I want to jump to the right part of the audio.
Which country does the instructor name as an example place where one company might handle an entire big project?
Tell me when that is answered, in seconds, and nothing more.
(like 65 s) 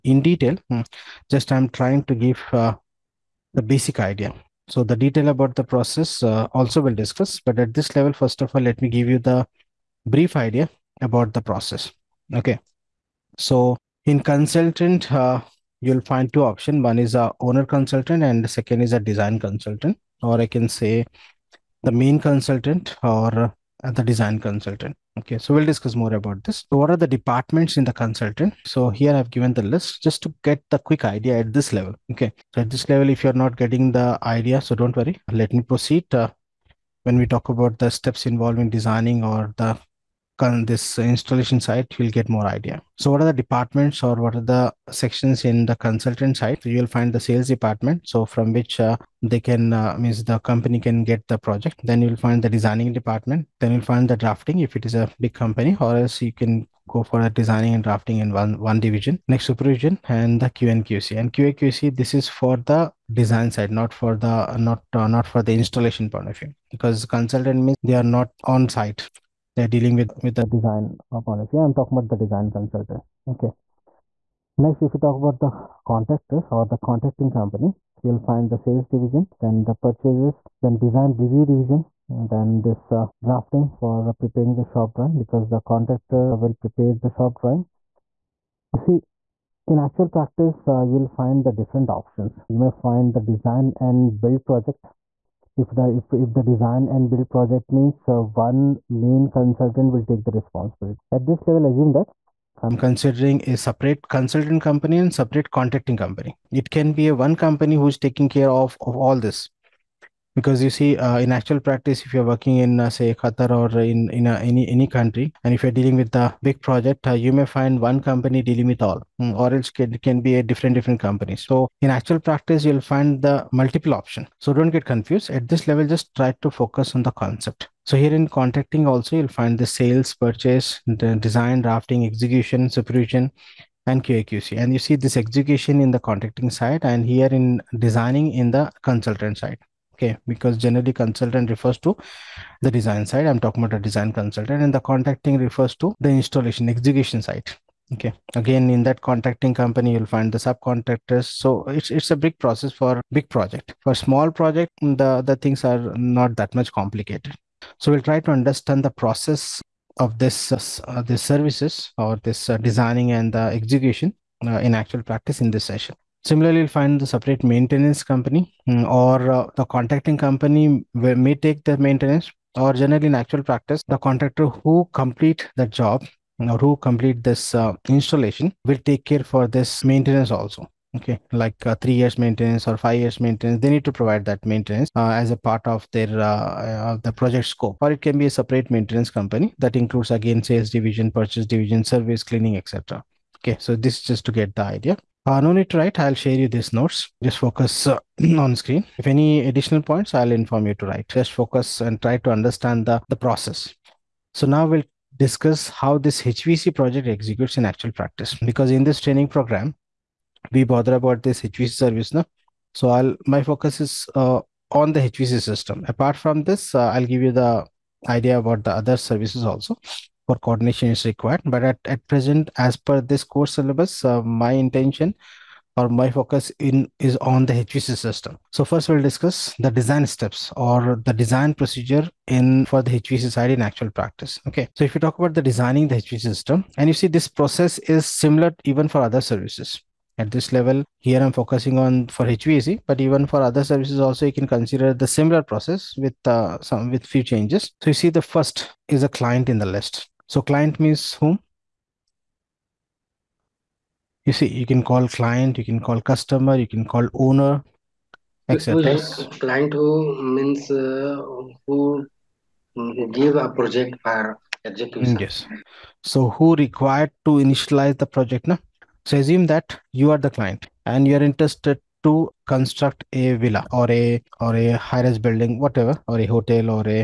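113 s.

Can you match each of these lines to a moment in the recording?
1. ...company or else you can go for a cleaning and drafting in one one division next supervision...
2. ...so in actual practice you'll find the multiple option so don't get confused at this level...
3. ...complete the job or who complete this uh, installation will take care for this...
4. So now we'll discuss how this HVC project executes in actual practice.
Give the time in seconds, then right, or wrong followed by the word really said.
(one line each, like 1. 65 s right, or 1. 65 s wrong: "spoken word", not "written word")
1. 55 s wrong: "designing", not "cleaning"
2. 121 s right
3. 174 s right
4. 204 s right.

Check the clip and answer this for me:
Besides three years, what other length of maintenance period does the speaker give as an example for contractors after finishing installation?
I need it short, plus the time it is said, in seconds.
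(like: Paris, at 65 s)
5 years, at 182 s.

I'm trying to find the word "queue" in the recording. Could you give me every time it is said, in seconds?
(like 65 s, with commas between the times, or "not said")
not said.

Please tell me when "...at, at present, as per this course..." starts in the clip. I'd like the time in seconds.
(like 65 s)
221 s.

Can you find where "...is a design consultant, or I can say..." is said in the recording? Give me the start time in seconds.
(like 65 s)
18 s.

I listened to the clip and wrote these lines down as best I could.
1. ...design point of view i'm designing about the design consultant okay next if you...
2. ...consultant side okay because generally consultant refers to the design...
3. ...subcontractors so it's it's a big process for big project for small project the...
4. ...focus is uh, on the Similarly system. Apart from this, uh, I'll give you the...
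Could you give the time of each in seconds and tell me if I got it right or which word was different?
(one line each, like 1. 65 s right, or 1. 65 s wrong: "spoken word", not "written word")
1. 70 s wrong: "talking", not "designing"
2. 138 s right
3. 150 s right
4. 213 s wrong: "HVC", not "Similarly".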